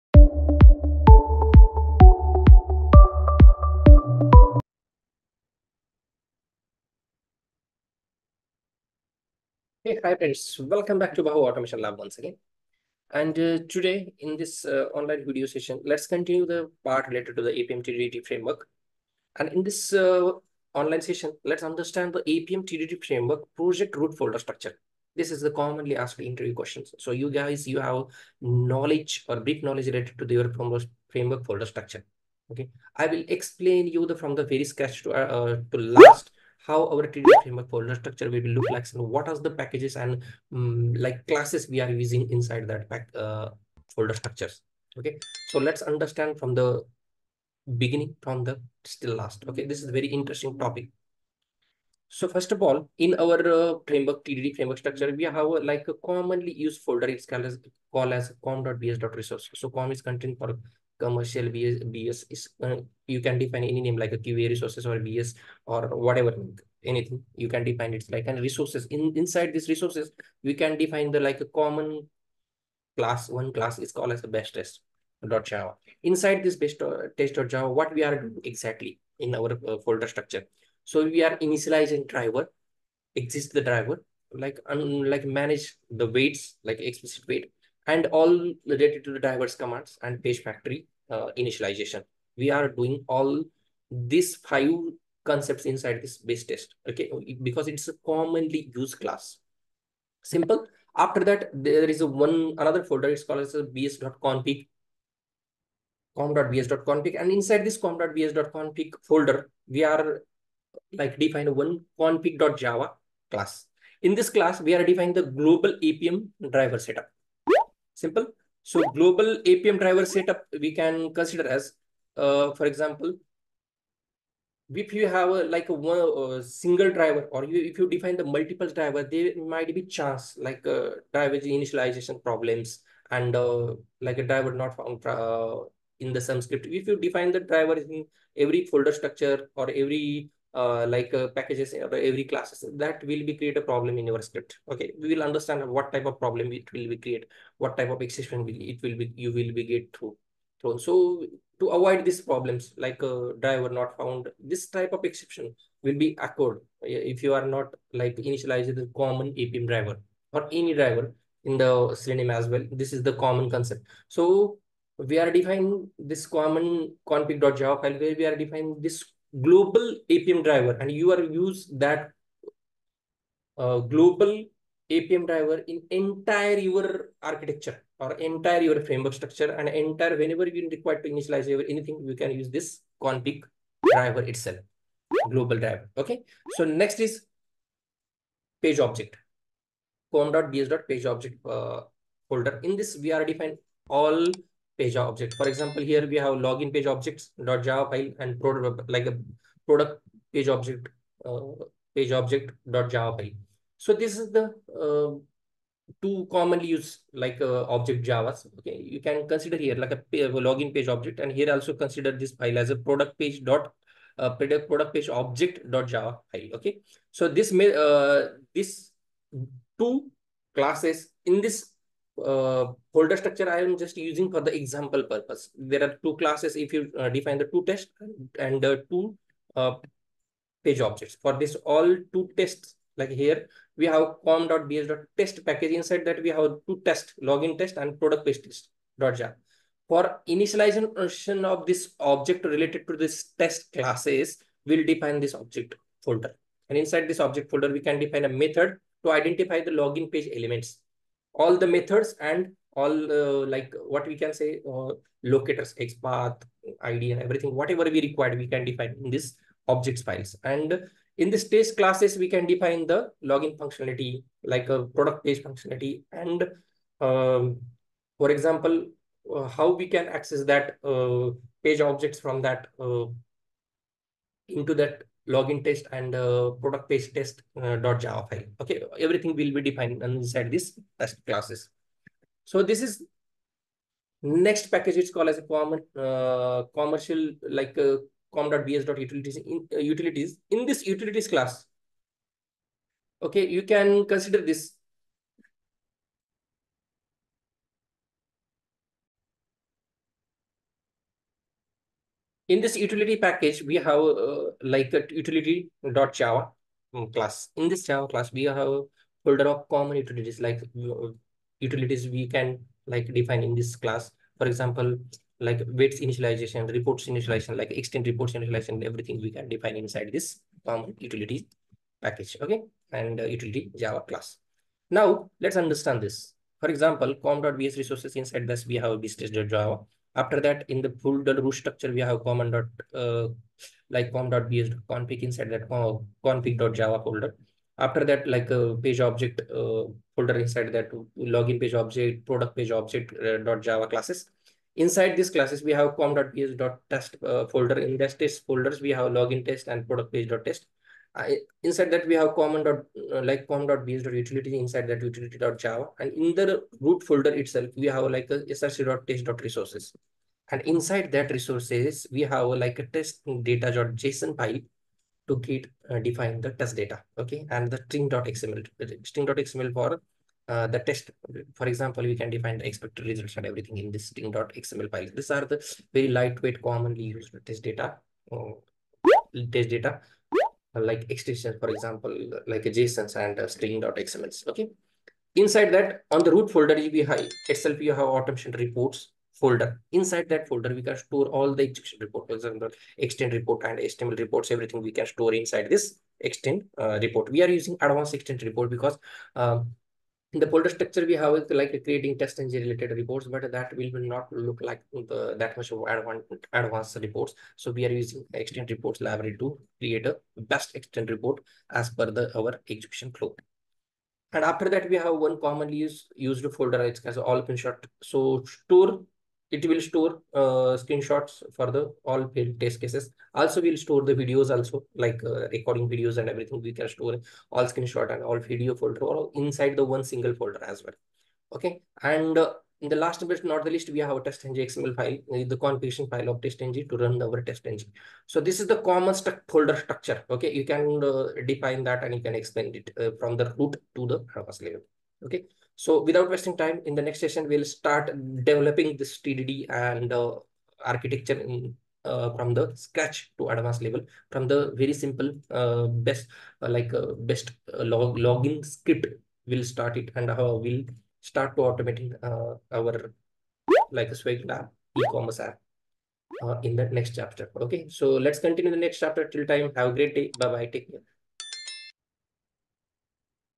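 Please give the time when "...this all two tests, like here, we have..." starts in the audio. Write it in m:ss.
3:51.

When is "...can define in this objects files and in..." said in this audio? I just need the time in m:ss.
4:18.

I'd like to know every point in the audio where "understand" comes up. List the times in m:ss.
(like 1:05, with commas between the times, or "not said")
0:21, 0:45, 2:25, 5:25.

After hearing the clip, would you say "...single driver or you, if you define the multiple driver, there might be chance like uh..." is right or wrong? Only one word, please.
right.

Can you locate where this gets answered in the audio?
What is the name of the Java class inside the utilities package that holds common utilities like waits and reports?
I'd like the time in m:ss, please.
5:05.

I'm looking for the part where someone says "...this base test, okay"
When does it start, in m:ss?
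1:36.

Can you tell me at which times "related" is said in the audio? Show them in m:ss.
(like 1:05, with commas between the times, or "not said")
0:17, 0:29, 1:28, 4:02, 6:42.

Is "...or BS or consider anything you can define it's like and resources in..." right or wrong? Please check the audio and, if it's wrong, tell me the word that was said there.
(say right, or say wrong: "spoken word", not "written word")
wrong: "whatever", not "consider".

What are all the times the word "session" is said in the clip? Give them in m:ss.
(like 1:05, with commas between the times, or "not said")
0:15, 0:21, 7:27.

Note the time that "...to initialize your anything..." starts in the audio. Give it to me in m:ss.
3:01.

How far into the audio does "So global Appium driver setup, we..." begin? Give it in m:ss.
1:58.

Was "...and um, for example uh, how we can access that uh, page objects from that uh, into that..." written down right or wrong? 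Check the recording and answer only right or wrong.
right.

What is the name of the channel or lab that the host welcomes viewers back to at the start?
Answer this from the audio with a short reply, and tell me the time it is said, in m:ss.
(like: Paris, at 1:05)
Bhau Automation Lab, at 0:11.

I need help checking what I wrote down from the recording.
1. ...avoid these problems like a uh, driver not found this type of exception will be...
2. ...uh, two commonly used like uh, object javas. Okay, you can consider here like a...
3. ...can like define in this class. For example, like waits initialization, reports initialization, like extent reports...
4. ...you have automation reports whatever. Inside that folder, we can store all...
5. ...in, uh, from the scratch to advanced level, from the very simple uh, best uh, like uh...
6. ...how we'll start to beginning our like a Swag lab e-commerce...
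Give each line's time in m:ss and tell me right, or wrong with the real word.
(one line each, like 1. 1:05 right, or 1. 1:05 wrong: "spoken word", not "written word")
1. 2:31 right
2. 3:24 right
3. 5:12 right
4. 6:27 wrong: "folder", not "whatever"
5. 7:31 right
6. 7:40 wrong: "automating", not "beginning".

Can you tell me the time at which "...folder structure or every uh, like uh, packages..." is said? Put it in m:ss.
2:18.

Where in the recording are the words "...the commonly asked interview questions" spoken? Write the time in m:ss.
0:25.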